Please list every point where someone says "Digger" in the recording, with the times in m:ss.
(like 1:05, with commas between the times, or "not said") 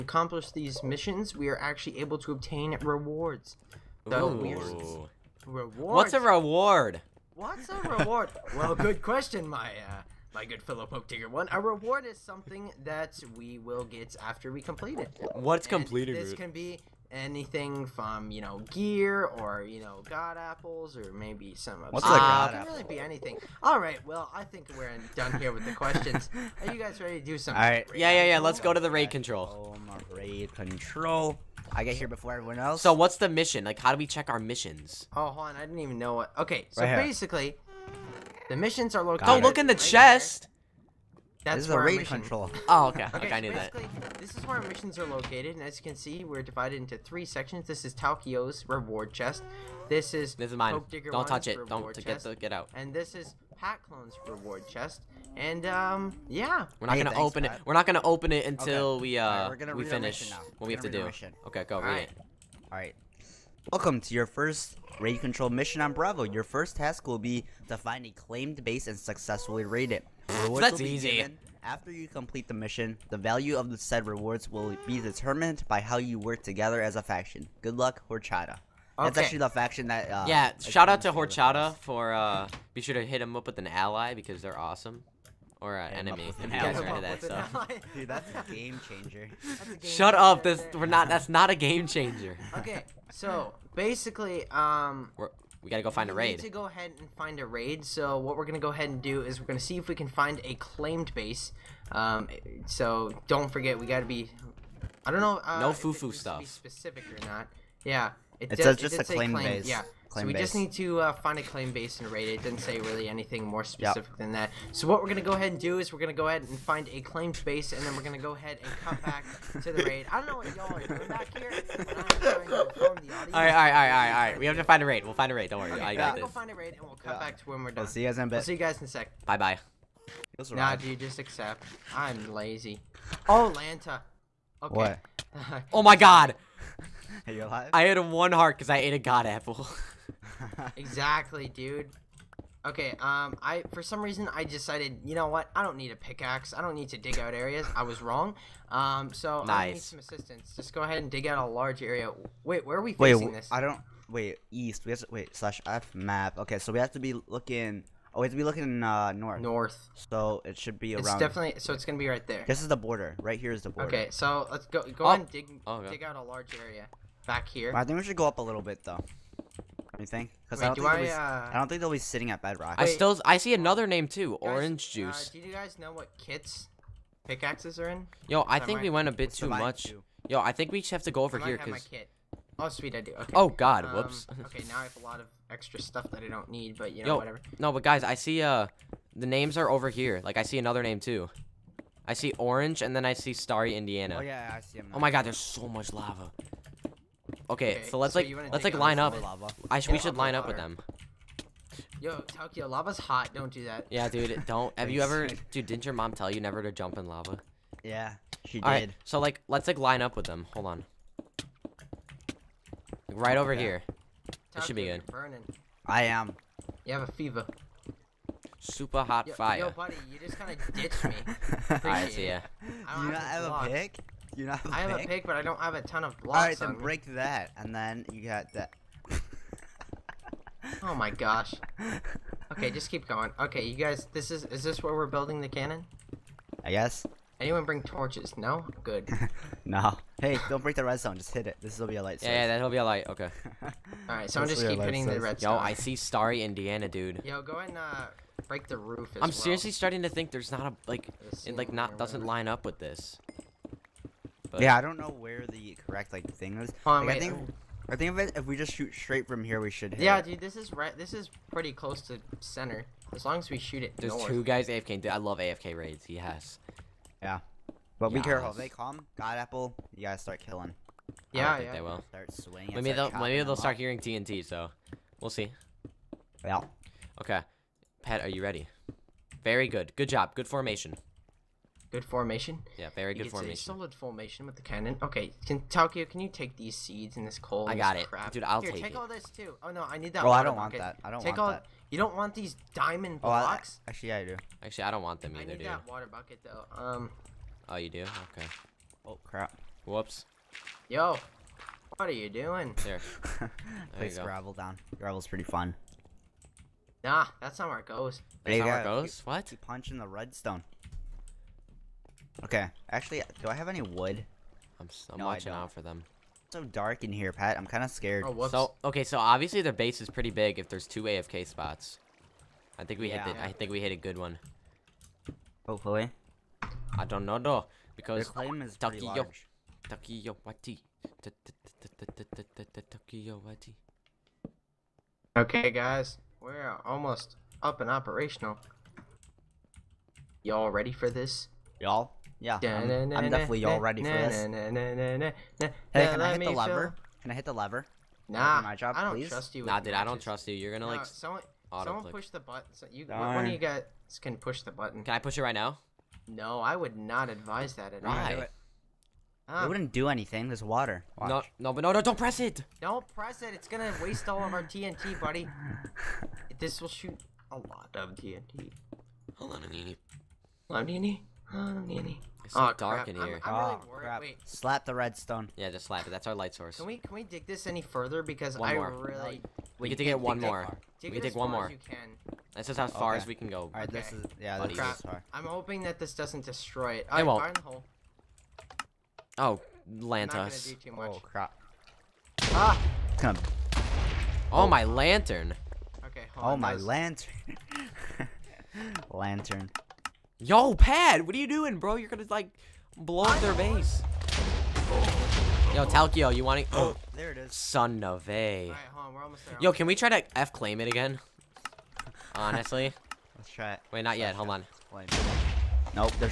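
0:11, 0:50.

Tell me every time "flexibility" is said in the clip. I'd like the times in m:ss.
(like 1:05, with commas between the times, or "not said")
not said.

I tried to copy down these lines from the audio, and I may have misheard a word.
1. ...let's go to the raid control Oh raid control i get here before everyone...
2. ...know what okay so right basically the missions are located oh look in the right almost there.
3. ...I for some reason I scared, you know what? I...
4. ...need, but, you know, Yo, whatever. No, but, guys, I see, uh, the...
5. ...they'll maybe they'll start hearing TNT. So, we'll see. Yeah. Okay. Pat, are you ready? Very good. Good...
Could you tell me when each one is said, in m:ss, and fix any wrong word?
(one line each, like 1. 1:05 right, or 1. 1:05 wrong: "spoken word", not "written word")
1. 0:28 right
2. 0:35 wrong: "chest", not "almost"
3. 2:23 wrong: "decided", not "scared"
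4. 3:06 right
5. 4:33 right.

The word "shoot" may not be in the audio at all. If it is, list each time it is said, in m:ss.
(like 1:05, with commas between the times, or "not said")
4:18, 4:23, 6:06.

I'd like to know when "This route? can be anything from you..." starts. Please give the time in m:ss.
0:16.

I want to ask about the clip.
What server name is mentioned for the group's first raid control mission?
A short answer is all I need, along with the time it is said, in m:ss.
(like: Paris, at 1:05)
Bravo, at 1:05.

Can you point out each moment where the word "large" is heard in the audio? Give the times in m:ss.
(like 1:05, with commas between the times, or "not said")
2:31, 2:46.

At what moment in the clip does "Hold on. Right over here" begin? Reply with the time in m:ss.
3:30.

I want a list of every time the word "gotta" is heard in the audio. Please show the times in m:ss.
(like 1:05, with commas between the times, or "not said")
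1:35, 1:43.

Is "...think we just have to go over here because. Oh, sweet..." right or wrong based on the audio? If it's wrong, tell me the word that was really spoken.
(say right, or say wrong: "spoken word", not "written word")
right.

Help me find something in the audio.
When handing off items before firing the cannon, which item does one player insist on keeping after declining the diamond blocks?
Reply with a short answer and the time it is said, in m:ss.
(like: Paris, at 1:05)
Water bucket, at 4:55.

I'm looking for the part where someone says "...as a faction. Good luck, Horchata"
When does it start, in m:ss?
1:16.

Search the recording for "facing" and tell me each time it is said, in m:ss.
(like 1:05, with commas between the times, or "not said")
2:32.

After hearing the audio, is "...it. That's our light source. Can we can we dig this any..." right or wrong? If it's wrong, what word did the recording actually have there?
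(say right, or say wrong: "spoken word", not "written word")
right.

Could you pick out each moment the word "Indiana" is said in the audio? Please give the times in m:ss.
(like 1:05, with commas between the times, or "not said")
3:13, 4:06.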